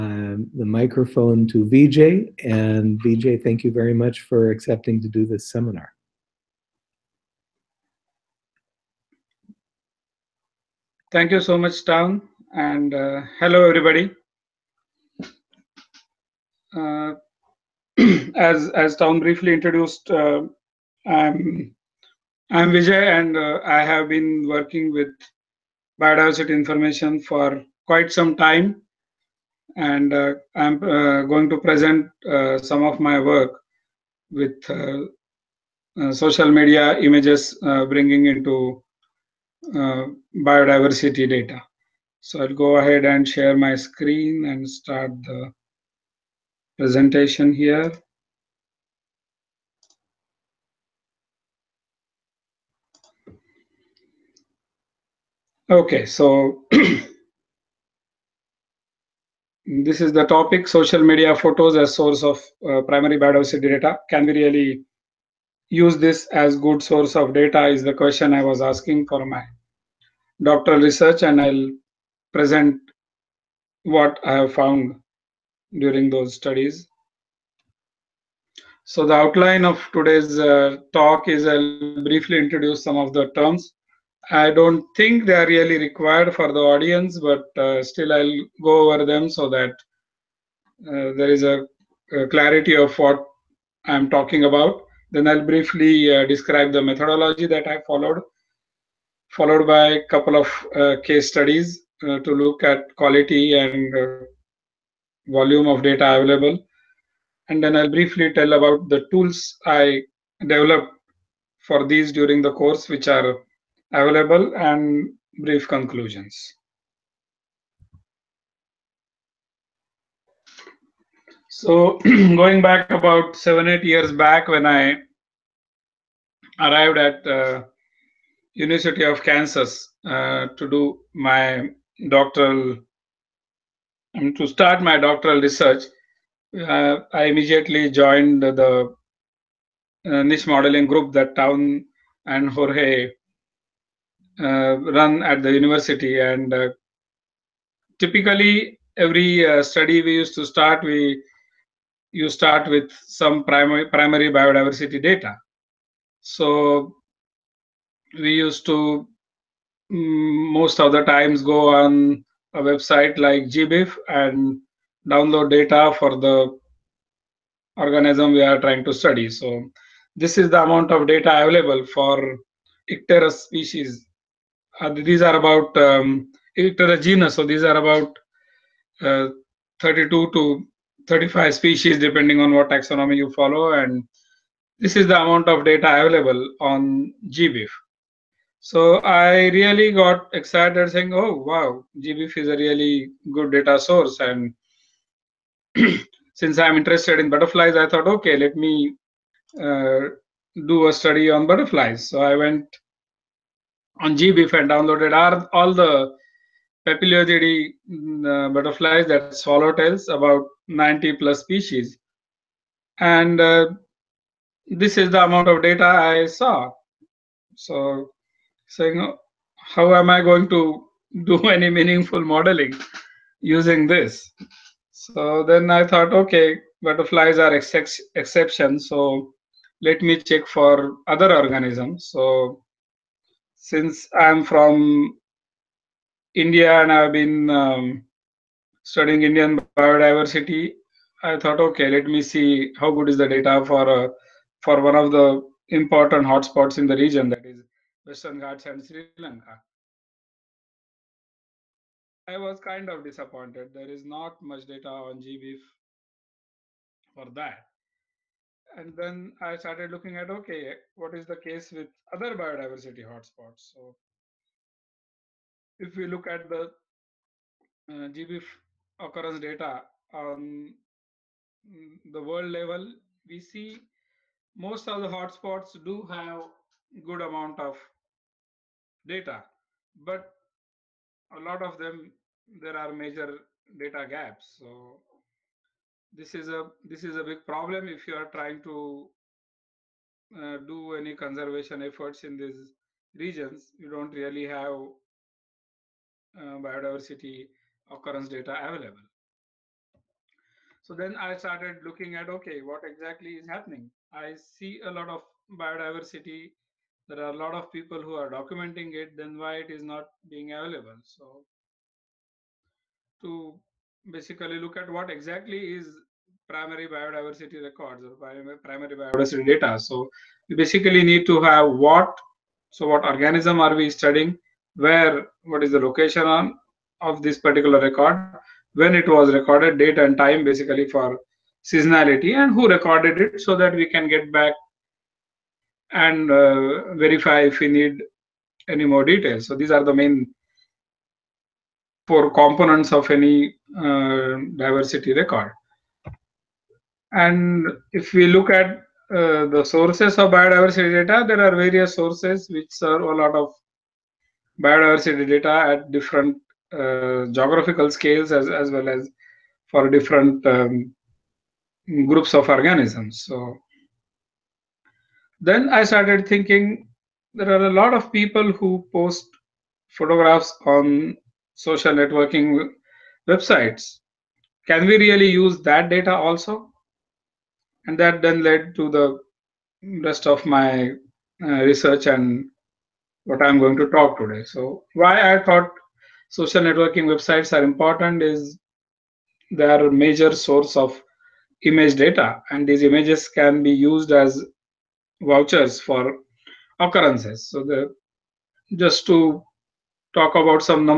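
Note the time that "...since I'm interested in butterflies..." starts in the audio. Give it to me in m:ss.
3:16.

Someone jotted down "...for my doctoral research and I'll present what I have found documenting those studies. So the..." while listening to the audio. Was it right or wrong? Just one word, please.
wrong.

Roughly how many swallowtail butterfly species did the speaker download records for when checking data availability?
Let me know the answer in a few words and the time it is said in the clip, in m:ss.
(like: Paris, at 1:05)
90, at 3:30.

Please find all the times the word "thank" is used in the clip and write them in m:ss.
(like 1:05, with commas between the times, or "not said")
0:03, 0:11.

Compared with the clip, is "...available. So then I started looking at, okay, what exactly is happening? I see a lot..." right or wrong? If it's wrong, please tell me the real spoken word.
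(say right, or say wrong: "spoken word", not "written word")
right.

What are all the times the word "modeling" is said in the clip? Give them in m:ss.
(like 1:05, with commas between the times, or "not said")
2:20, 3:42.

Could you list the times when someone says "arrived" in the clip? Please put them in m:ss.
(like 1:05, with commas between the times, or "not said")
2:06.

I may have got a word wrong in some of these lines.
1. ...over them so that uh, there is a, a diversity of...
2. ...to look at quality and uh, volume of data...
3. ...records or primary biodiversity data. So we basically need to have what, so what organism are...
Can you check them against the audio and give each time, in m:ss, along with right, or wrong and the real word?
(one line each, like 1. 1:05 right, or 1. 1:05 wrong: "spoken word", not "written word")
1. 1:28 wrong: "clarity", not "diversity"
2. 1:42 right
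3. 5:17 right.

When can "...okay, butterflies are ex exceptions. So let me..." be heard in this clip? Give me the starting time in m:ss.
3:46.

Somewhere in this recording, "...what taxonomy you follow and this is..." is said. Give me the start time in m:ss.
3:02.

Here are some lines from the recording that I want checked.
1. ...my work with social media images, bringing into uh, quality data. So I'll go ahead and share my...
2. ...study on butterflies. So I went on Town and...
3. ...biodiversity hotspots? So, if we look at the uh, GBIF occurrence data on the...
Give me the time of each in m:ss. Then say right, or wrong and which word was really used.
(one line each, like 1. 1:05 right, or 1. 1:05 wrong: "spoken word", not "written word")
1. 0:33 wrong: "biodiversity", not "quality"
2. 3:20 wrong: "GBIF", not "Town"
3. 4:22 right.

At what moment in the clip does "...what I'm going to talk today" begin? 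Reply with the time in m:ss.
6:23.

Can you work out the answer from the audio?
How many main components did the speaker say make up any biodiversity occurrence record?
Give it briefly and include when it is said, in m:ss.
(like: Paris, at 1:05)
4, at 5:42.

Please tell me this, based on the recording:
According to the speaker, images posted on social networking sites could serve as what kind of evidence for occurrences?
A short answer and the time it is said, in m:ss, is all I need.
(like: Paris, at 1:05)
vouchers, at 6:35.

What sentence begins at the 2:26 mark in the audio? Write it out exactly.
And uh, typically every study we used to start, we you start with some primary primary biodiversity data.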